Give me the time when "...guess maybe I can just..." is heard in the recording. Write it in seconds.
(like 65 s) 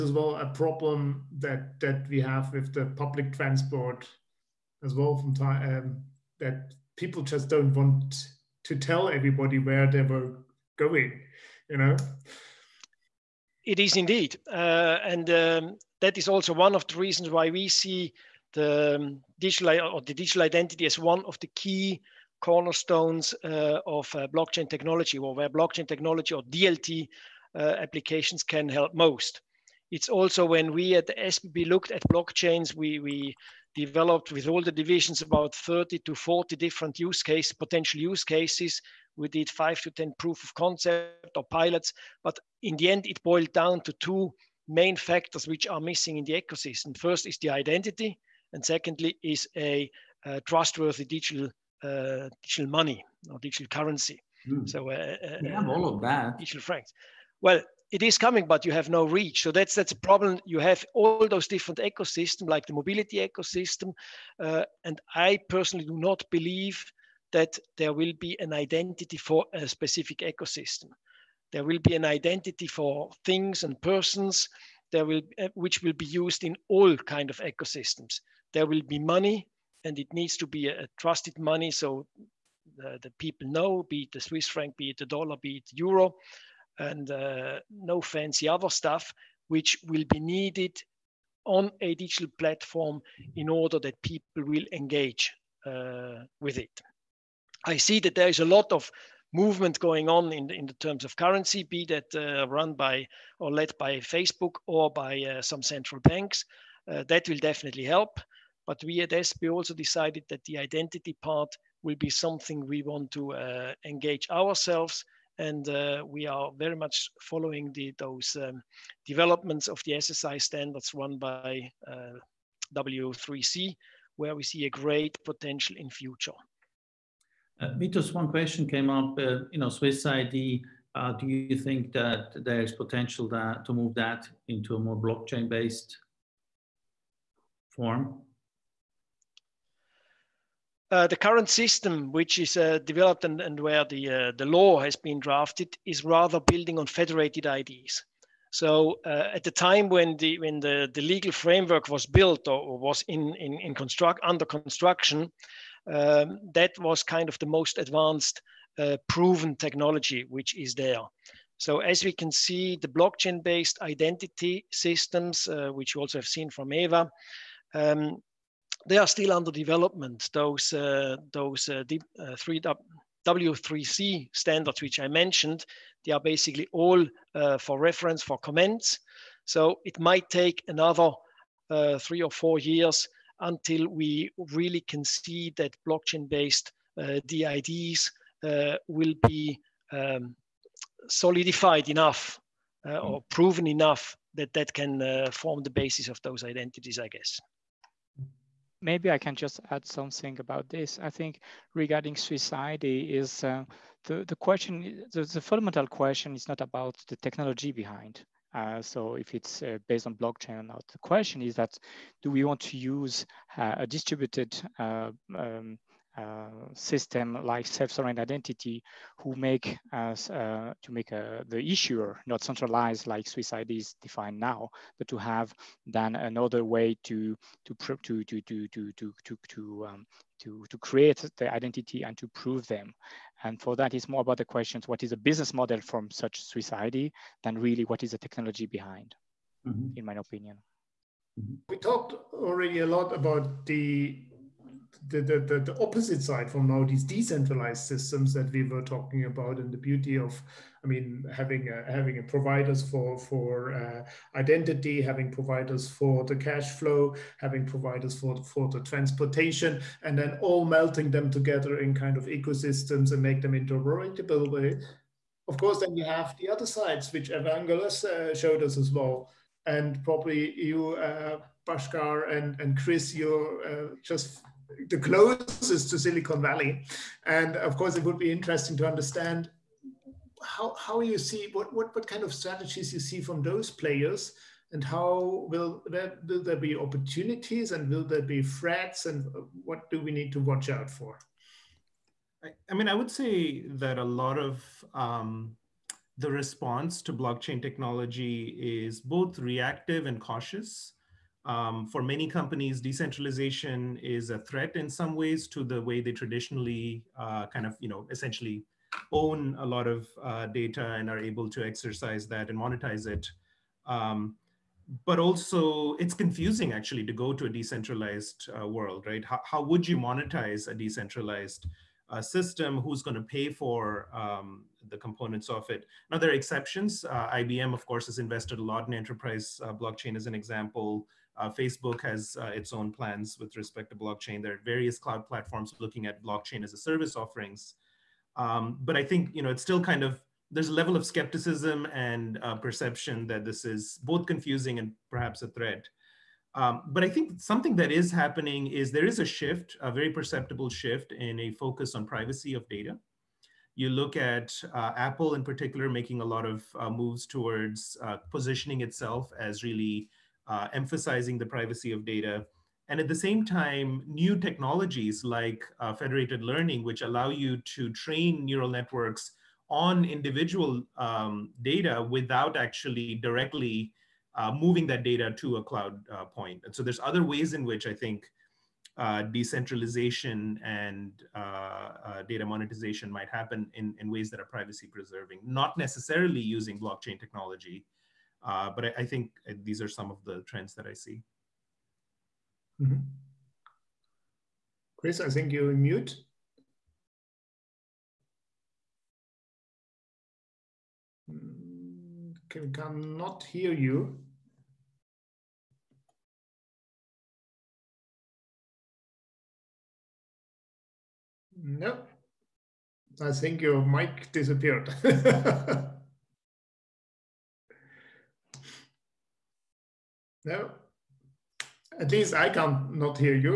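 197 s.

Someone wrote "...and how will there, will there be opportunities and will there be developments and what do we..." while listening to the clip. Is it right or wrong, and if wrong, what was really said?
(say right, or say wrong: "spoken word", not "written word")
wrong: "threats", not "developments".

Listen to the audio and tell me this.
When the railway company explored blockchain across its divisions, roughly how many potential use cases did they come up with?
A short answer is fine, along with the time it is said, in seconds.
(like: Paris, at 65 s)
30 to 40, at 35 s.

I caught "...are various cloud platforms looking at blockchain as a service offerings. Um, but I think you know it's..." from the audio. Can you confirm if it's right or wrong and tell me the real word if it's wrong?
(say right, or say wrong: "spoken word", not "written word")
right.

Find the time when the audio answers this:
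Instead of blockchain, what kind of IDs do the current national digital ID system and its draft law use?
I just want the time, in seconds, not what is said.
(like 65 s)
146 s.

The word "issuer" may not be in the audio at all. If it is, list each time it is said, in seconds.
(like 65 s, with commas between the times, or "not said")
221 s.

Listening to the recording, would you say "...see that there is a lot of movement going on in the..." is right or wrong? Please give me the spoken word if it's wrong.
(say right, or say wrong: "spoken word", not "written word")
right.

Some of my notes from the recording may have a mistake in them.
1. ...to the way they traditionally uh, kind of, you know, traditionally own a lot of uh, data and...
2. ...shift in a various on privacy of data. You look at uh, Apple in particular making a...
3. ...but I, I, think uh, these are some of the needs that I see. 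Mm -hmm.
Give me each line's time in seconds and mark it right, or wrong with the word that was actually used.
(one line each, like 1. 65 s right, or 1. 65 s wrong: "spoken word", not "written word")
1. 305 s wrong: "essentially", not "traditionally"
2. 350 s wrong: "focus", not "various"
3. 388 s wrong: "trends", not "needs".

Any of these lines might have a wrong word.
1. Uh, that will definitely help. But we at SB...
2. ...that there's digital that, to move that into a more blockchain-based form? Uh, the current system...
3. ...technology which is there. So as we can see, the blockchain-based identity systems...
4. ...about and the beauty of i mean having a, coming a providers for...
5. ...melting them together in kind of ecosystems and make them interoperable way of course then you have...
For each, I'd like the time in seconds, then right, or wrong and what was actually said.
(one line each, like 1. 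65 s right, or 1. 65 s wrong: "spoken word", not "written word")
1. 106 s right
2. 131 s wrong: "potential", not "digital"
3. 159 s right
4. 249 s wrong: "having", not "coming"
5. 260 s right.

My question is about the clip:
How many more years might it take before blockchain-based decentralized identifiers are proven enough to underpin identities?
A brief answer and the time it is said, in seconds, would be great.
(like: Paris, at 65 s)
3 or 4 years, at 182 s.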